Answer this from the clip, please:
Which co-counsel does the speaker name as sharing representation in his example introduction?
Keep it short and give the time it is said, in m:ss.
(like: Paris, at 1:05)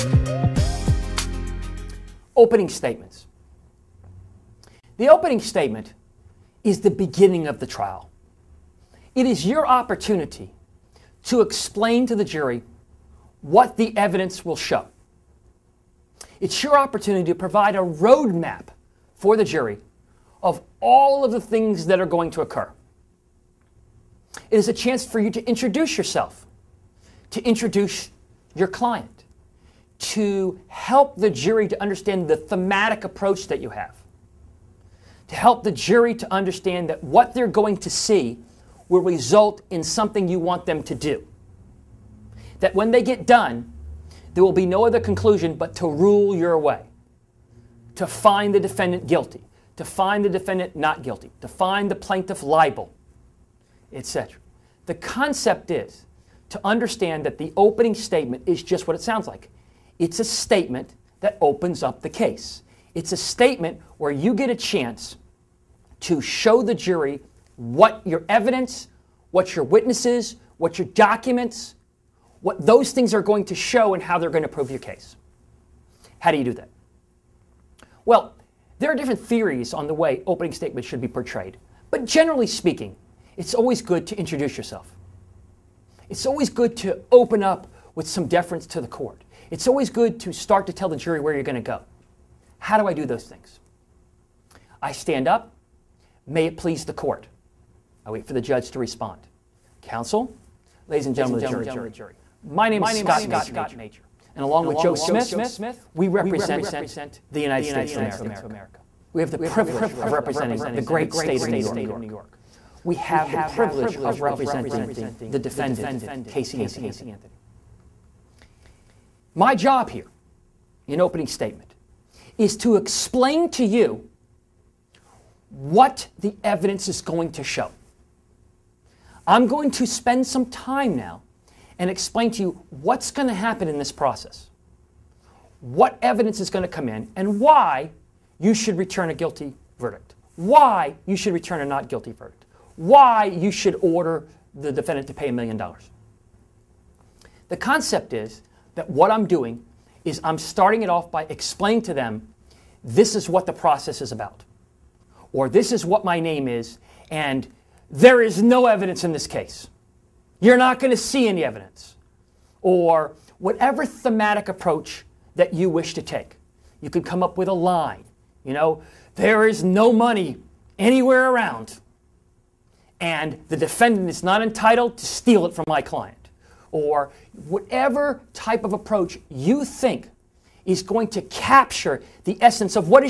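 Joe Smith, at 1:44.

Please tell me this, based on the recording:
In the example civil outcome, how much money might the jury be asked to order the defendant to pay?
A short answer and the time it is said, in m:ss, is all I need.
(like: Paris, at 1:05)
$1,000,000, at 2:25.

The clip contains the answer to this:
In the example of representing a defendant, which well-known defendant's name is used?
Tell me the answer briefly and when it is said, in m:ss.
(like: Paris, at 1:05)
Casey Anthony, at 1:56.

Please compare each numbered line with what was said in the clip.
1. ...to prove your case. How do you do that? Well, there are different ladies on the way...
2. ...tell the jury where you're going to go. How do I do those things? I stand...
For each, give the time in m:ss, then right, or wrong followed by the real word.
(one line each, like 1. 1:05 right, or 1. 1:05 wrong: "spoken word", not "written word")
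1. 1:14 wrong: "theories", not "ladies"
2. 1:30 right.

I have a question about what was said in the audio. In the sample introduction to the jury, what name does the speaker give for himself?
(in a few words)
Scott Mager.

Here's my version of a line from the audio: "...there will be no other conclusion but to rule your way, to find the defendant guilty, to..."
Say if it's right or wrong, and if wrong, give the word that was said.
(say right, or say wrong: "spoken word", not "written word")
right.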